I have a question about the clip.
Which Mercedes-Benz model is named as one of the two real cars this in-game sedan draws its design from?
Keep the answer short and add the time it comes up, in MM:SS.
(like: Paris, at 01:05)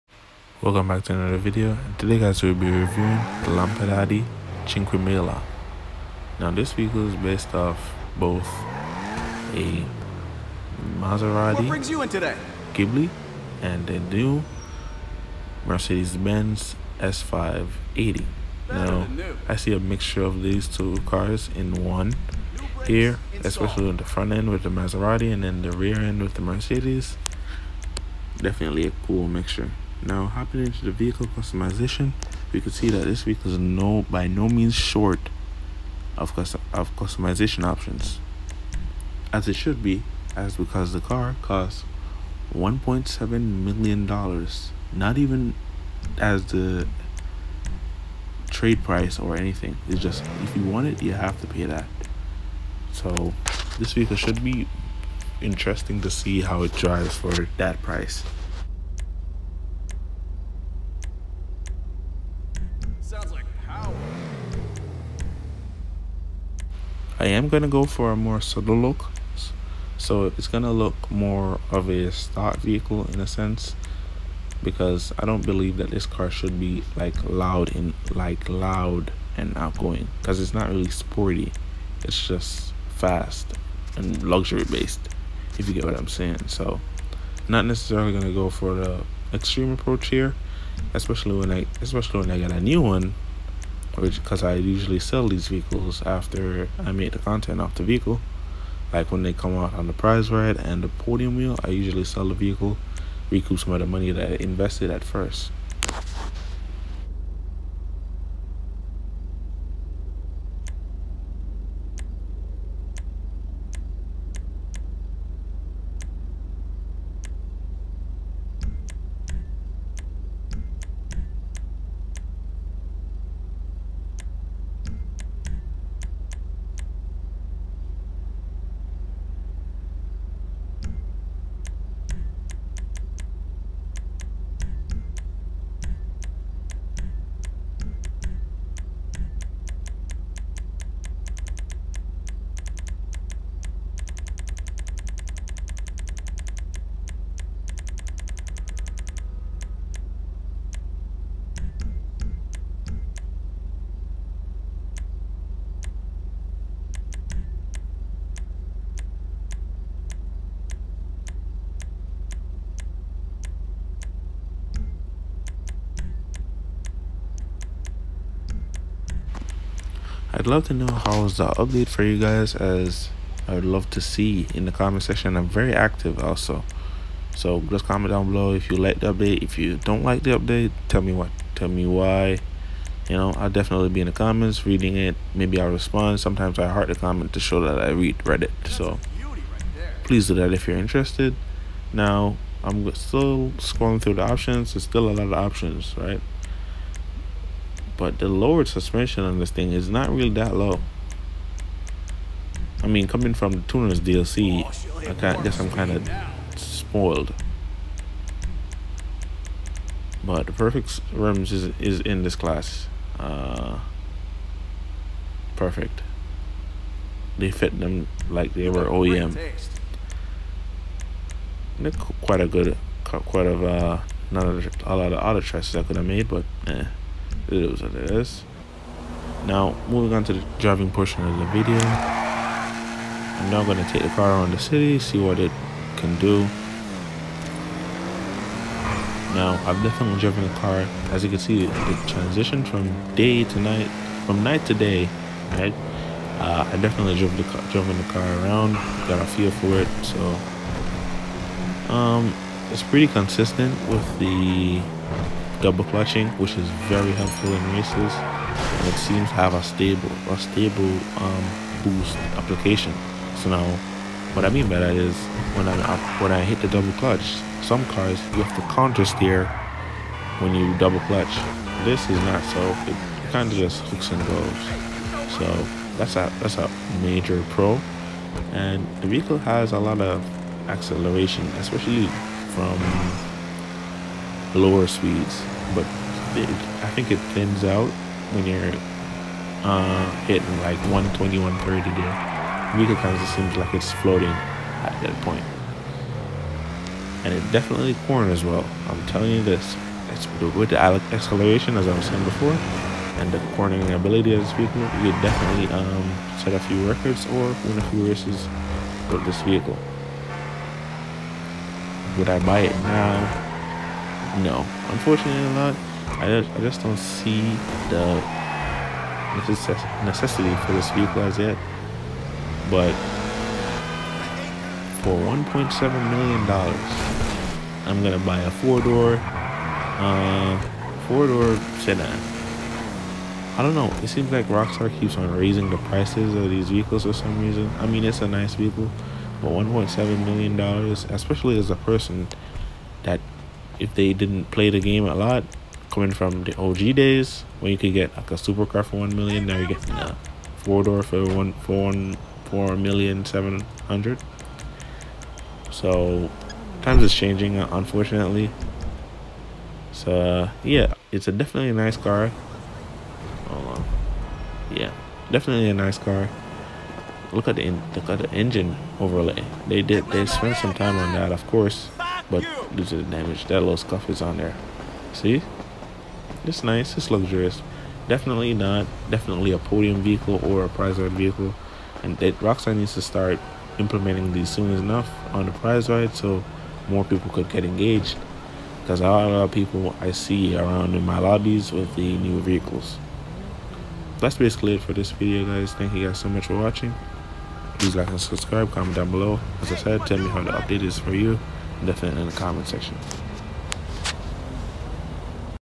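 S580, at 00:16.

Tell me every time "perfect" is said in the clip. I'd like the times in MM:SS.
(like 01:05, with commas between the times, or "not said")
03:30, 03:35.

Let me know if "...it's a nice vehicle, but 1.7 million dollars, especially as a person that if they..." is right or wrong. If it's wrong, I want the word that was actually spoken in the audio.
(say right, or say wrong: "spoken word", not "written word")
right.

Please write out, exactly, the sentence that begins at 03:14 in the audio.
There's still a lot of options, right?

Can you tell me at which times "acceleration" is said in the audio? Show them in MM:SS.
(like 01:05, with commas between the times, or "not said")
04:40, 05:00.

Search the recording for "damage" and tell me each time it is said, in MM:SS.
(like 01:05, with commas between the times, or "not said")
06:13.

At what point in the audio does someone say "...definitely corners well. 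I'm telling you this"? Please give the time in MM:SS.
04:57.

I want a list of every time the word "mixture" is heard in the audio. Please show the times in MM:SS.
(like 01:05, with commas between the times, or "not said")
00:19, 00:29.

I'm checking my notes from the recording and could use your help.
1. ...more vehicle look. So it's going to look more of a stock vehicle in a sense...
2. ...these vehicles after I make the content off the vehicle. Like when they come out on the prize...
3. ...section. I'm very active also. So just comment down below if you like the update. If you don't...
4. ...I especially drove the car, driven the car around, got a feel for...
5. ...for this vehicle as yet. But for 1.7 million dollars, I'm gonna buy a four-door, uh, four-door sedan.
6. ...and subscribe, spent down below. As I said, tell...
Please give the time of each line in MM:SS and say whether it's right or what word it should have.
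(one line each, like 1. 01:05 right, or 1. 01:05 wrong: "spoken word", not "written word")
1. 01:08 wrong: "subtle", not "vehicle"
2. 01:35 right
3. 02:55 right
4. 04:06 wrong: "definitely", not "especially"
5. 05:20 right
6. 06:38 wrong: "comment", not "spent".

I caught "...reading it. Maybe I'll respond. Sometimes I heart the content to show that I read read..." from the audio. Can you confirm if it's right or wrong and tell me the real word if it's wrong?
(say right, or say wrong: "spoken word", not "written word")
wrong: "comment", not "content".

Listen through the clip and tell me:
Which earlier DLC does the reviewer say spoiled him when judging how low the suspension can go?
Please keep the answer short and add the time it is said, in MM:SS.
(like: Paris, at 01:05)
Tuner's DLC, at 03:23.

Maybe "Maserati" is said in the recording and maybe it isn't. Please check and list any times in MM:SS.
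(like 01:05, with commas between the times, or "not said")
00:10, 00:24.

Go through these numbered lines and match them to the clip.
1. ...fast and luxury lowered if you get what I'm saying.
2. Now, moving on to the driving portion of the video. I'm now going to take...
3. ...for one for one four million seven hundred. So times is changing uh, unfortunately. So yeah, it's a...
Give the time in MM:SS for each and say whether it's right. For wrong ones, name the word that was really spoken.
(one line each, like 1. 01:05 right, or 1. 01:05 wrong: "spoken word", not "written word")
1. 01:22 wrong: "based", not "lowered"
2. 03:49 right
3. 05:51 right.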